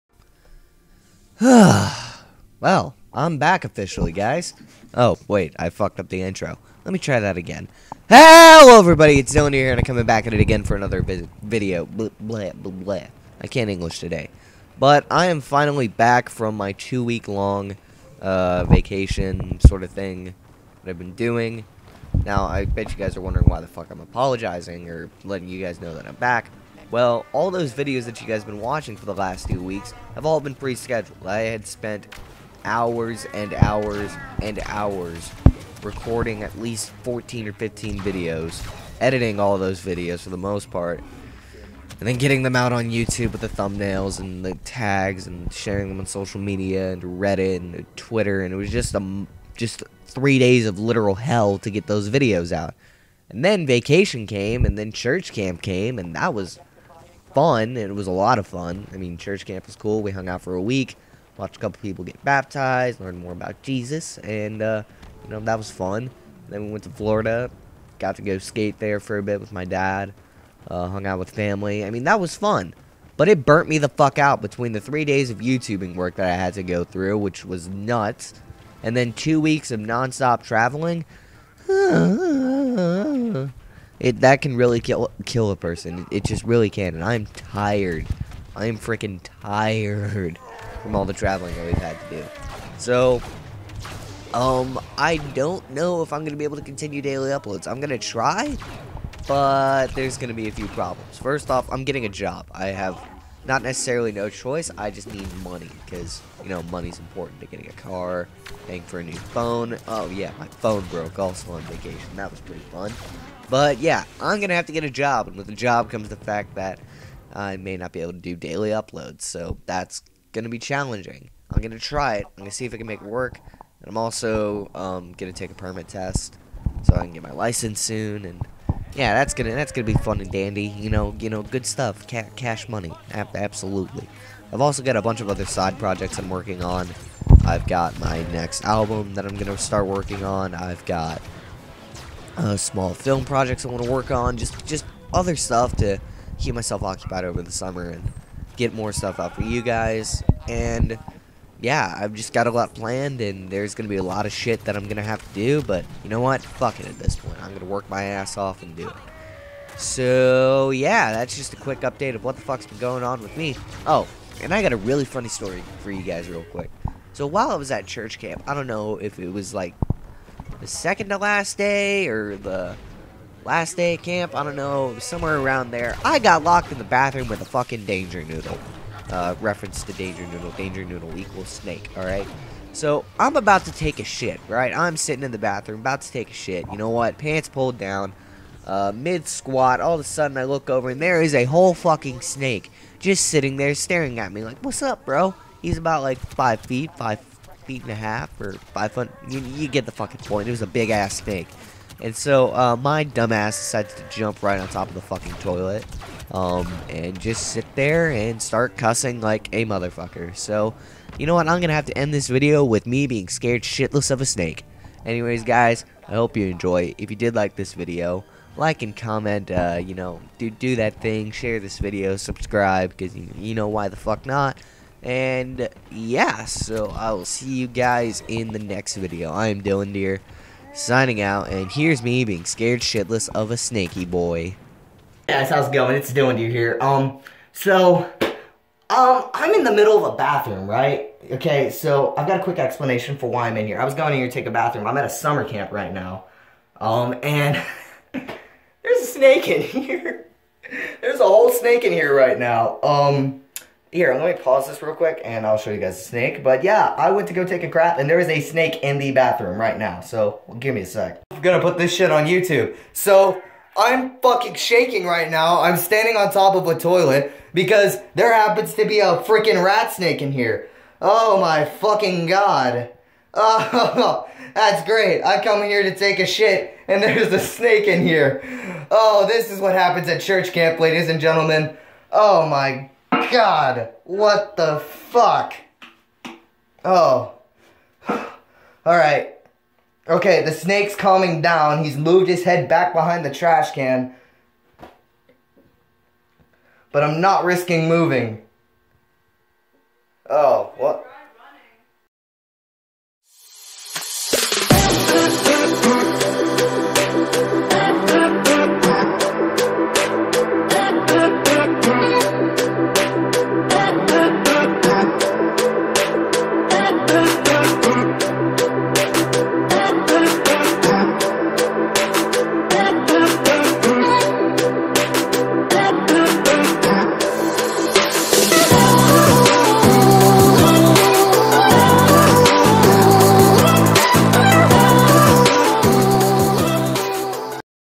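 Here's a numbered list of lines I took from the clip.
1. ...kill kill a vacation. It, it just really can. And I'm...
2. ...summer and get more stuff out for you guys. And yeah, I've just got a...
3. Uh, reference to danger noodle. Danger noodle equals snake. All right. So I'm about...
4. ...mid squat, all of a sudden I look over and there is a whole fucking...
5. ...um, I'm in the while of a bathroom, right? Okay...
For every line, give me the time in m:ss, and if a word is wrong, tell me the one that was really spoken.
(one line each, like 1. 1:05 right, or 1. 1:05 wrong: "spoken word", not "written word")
1. 1:24 wrong: "person", not "vacation"
2. 2:27 right
3. 2:59 right
4. 3:08 right
5. 3:58 wrong: "middle", not "while".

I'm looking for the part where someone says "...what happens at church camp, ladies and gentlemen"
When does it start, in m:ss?
4:39.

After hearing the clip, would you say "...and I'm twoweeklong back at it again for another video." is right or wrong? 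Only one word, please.
wrong.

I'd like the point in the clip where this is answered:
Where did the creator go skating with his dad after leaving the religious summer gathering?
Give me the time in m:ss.
1:06.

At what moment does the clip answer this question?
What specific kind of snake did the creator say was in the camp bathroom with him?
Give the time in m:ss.
4:29.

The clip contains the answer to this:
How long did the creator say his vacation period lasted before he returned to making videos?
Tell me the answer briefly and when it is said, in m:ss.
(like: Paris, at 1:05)
2 weeks, at 0:16.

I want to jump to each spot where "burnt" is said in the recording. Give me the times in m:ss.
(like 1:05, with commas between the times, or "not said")
1:13.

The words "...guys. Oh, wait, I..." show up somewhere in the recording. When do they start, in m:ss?
0:04.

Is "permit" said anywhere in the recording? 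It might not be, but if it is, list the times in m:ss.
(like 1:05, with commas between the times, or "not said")
2:05.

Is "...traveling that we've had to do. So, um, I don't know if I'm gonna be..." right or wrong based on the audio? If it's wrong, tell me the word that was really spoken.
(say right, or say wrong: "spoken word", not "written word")
right.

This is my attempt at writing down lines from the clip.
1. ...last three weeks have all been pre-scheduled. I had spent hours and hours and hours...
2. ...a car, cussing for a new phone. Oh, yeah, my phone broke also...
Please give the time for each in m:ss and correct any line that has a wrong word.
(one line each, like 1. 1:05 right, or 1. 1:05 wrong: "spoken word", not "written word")
1. 0:29 wrong: "two", not "three"
2. 1:47 wrong: "paying", not "cussing".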